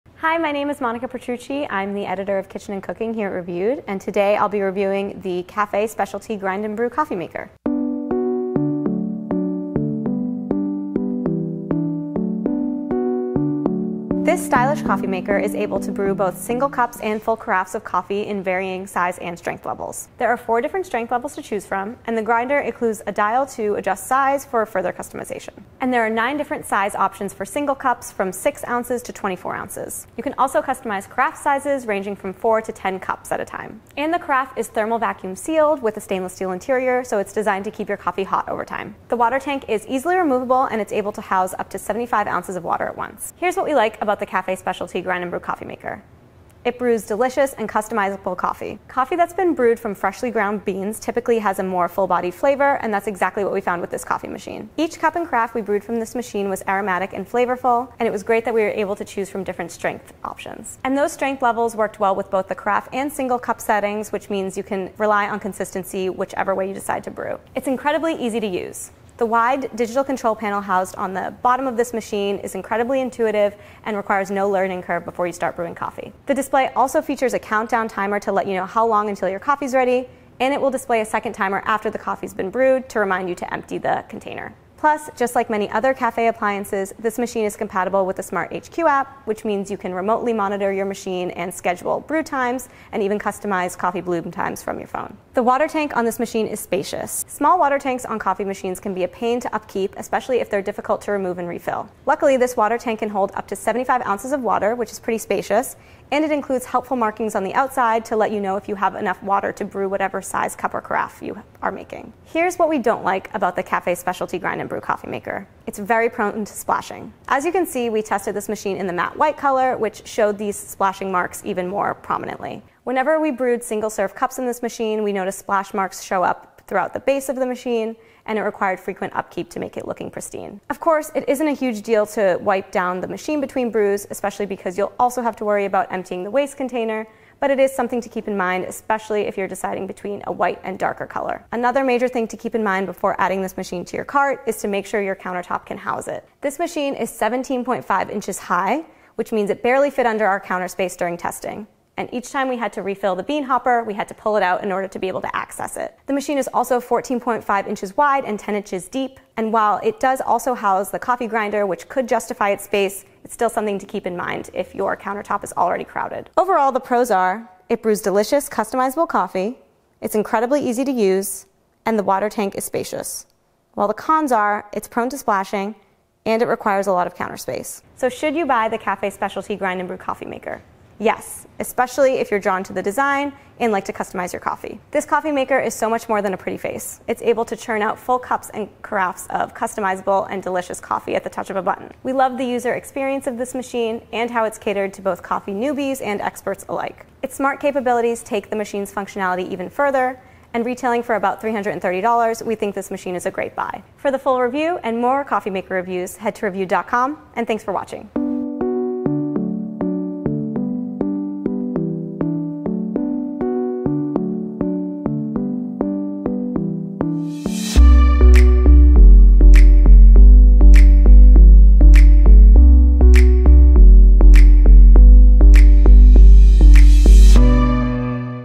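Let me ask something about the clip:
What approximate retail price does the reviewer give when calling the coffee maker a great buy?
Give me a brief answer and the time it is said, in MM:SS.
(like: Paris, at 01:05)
$330, at 03:21.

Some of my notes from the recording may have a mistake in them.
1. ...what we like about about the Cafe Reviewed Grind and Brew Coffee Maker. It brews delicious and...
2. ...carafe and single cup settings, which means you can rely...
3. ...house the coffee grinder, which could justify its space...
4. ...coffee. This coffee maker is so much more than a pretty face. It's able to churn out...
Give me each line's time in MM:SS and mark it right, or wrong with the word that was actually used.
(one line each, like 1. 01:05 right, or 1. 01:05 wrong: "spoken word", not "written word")
1. 00:43 wrong: "Specialty", not "Reviewed"
2. 01:02 right
3. 02:40 right
4. 03:04 right.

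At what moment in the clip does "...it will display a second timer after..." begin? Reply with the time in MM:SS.
01:20.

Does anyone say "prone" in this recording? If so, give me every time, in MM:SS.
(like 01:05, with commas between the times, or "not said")
01:56, 02:54.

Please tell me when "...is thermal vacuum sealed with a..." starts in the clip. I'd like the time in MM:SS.
00:34.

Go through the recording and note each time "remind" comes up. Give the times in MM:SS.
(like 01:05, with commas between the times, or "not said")
01:22.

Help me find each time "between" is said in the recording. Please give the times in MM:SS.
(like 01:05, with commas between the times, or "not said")
02:13, 02:19.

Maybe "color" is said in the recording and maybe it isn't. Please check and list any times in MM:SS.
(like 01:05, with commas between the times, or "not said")
01:59, 02:21.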